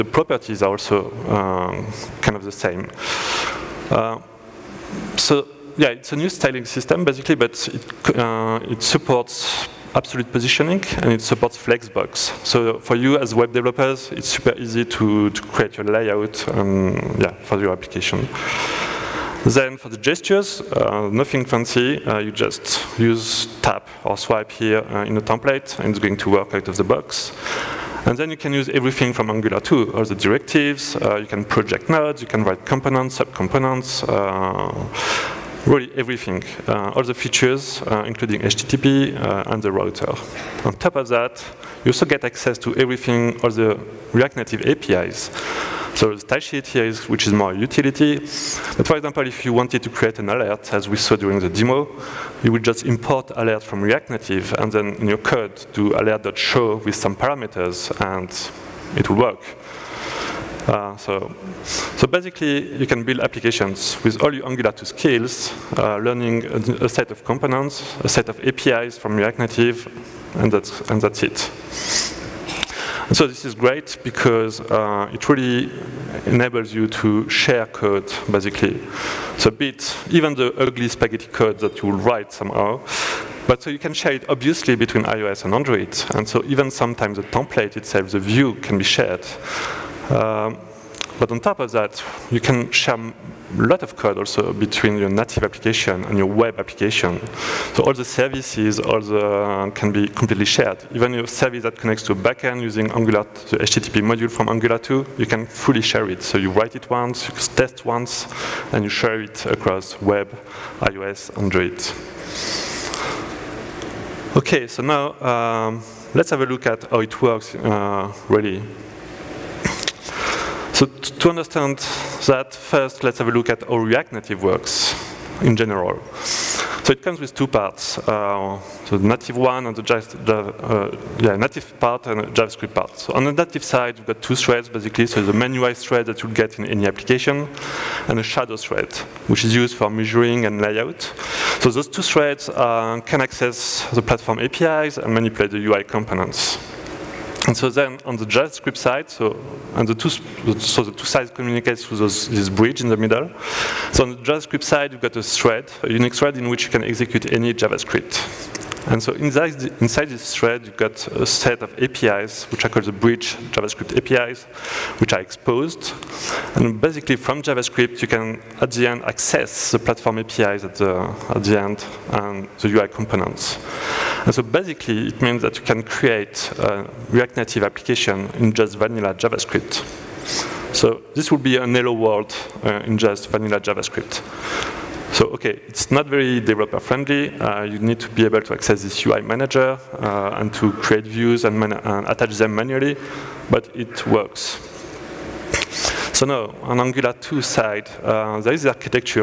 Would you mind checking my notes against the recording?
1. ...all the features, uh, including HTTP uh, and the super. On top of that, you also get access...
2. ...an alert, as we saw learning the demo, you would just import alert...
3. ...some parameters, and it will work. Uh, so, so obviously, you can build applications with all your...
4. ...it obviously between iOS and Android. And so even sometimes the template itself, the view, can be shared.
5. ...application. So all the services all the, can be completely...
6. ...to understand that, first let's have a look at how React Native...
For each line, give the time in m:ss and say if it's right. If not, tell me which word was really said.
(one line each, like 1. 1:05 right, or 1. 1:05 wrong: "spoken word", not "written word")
1. 0:36 wrong: "router", not "super"
2. 0:50 wrong: "during", not "learning"
3. 0:56 wrong: "basically", not "obviously"
4. 1:24 right
5. 1:36 right
6. 2:00 right.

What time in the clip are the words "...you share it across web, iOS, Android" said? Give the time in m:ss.
1:48.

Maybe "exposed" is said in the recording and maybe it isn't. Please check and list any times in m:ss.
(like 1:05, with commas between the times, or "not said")
2:45.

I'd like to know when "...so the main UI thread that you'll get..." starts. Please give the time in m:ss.
2:15.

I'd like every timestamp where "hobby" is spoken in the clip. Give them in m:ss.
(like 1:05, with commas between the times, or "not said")
not said.